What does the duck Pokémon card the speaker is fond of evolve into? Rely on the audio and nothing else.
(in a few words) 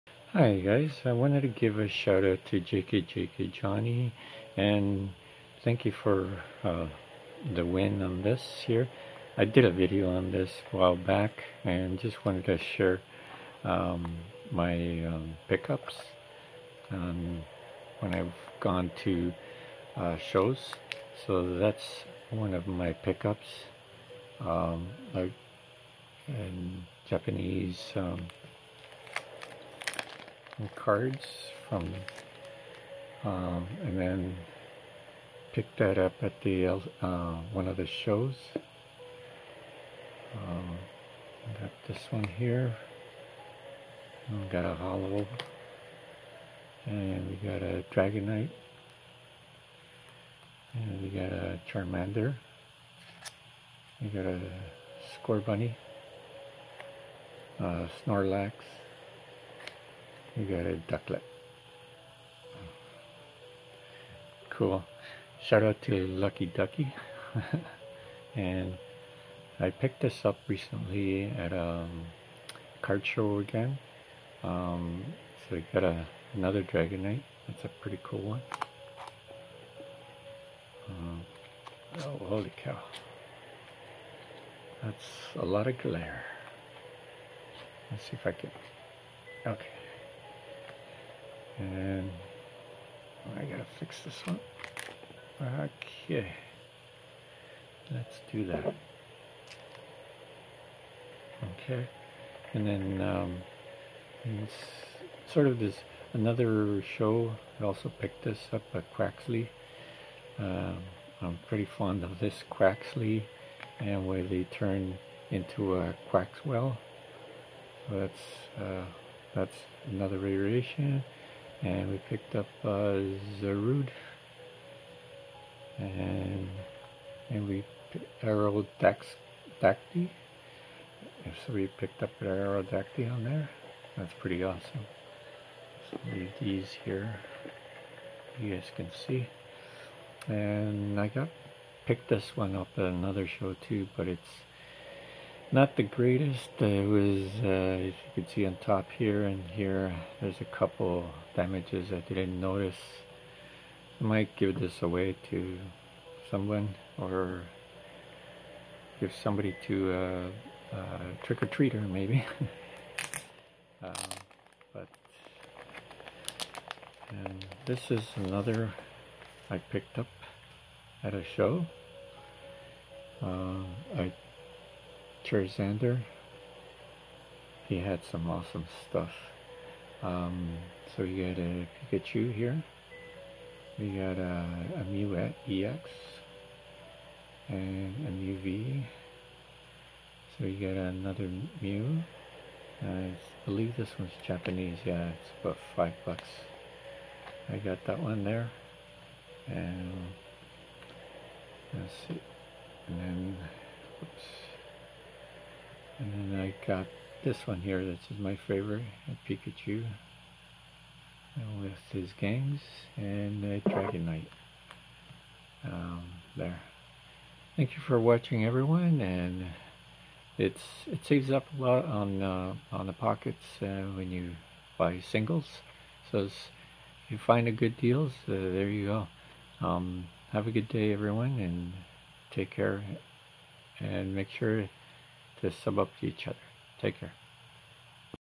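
Quaxwell.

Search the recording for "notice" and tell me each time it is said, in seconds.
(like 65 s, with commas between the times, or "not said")
152 s.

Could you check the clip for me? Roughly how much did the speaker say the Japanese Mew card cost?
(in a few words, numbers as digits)
$5.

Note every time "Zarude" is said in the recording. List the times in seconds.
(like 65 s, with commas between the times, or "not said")
123 s.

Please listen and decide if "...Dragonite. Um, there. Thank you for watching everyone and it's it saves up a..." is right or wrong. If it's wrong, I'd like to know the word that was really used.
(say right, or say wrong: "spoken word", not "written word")
right.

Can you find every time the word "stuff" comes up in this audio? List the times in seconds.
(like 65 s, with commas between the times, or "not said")
178 s.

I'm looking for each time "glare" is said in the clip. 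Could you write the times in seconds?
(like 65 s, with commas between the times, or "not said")
85 s.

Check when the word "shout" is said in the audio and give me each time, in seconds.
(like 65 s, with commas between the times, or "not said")
1 s, 65 s.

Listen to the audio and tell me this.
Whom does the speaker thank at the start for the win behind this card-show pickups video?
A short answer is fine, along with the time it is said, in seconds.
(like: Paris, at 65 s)
JK JK Johnny, at 2 s.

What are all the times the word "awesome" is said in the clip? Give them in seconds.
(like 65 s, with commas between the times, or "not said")
134 s, 178 s.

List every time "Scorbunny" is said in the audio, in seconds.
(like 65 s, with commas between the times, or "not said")
55 s.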